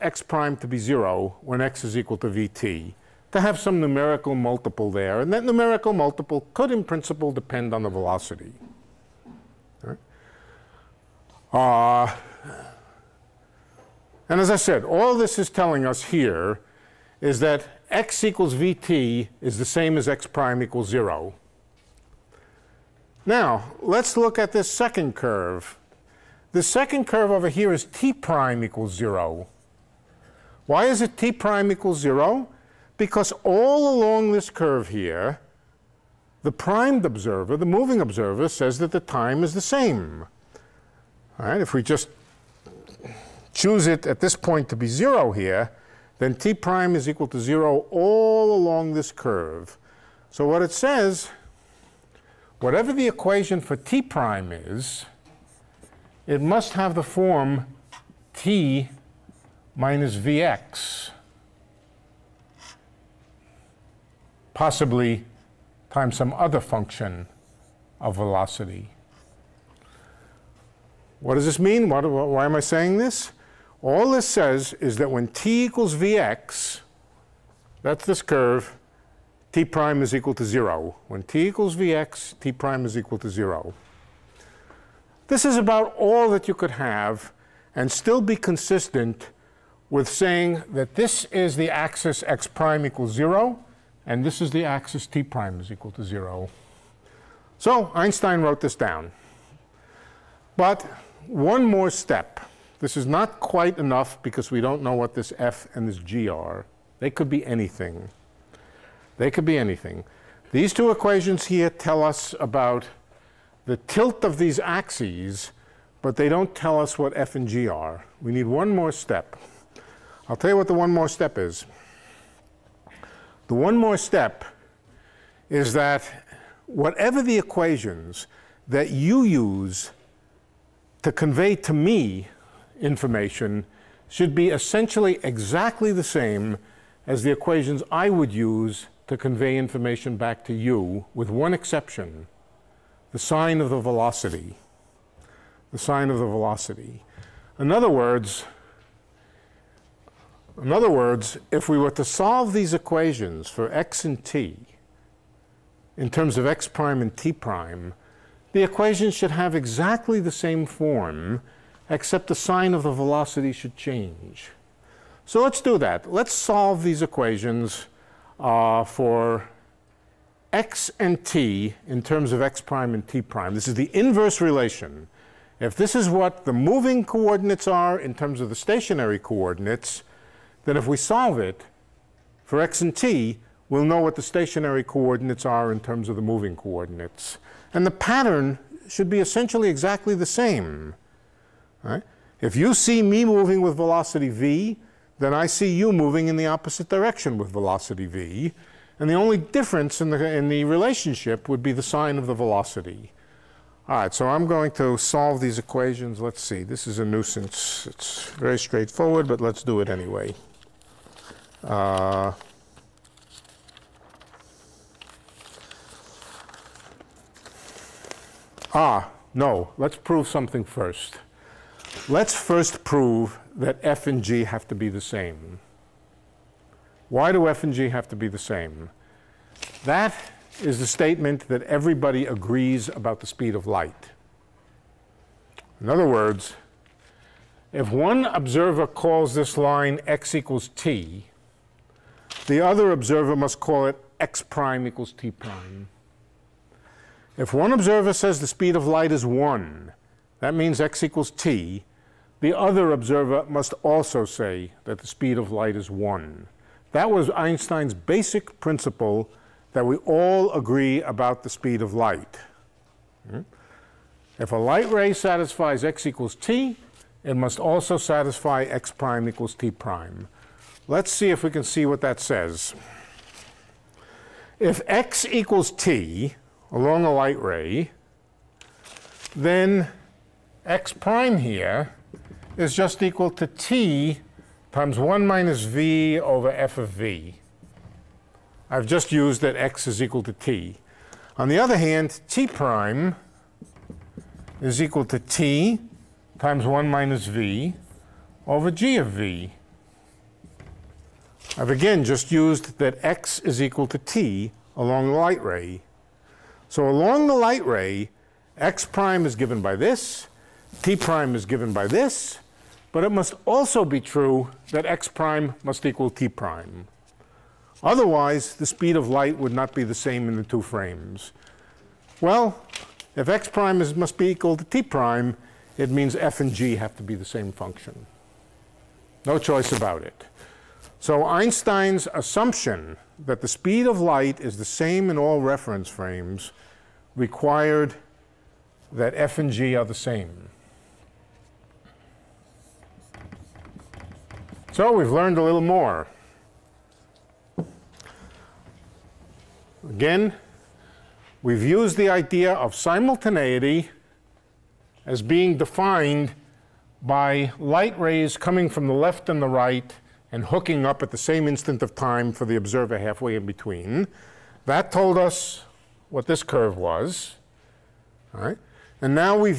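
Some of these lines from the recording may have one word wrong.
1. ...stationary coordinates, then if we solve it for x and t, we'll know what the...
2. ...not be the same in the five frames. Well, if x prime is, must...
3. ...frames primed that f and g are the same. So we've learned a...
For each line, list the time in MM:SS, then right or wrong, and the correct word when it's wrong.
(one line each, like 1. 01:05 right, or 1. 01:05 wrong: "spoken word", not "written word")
1. 02:58 right
2. 05:19 wrong: "two", not "five"
3. 05:35 wrong: "required", not "primed".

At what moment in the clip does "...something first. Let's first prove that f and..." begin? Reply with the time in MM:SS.
03:40.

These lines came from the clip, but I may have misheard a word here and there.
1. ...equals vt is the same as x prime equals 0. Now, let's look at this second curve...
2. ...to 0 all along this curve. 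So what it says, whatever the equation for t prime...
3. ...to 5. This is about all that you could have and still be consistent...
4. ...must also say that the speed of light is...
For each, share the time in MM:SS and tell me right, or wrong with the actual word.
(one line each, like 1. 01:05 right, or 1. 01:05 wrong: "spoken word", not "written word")
1. 00:18 right
2. 00:47 right
3. 01:23 wrong: "0", not "5"
4. 04:13 right.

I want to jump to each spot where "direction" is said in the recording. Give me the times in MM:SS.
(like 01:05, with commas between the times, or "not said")
03:16.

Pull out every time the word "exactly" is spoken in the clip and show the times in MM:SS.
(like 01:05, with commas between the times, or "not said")
02:15, 02:39, 03:09.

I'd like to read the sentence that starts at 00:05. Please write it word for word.
And that numerical multiple could, in principle, depend on the velocity.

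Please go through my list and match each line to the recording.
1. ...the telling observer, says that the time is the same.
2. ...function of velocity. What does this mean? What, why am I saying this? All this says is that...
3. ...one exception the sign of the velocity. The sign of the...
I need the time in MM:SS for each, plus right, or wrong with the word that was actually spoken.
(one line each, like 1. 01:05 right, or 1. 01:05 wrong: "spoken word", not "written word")
1. 00:37 wrong: "moving", not "telling"
2. 01:06 right
3. 02:21 right.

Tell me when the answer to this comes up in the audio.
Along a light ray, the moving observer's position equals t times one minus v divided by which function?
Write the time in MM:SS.
04:46.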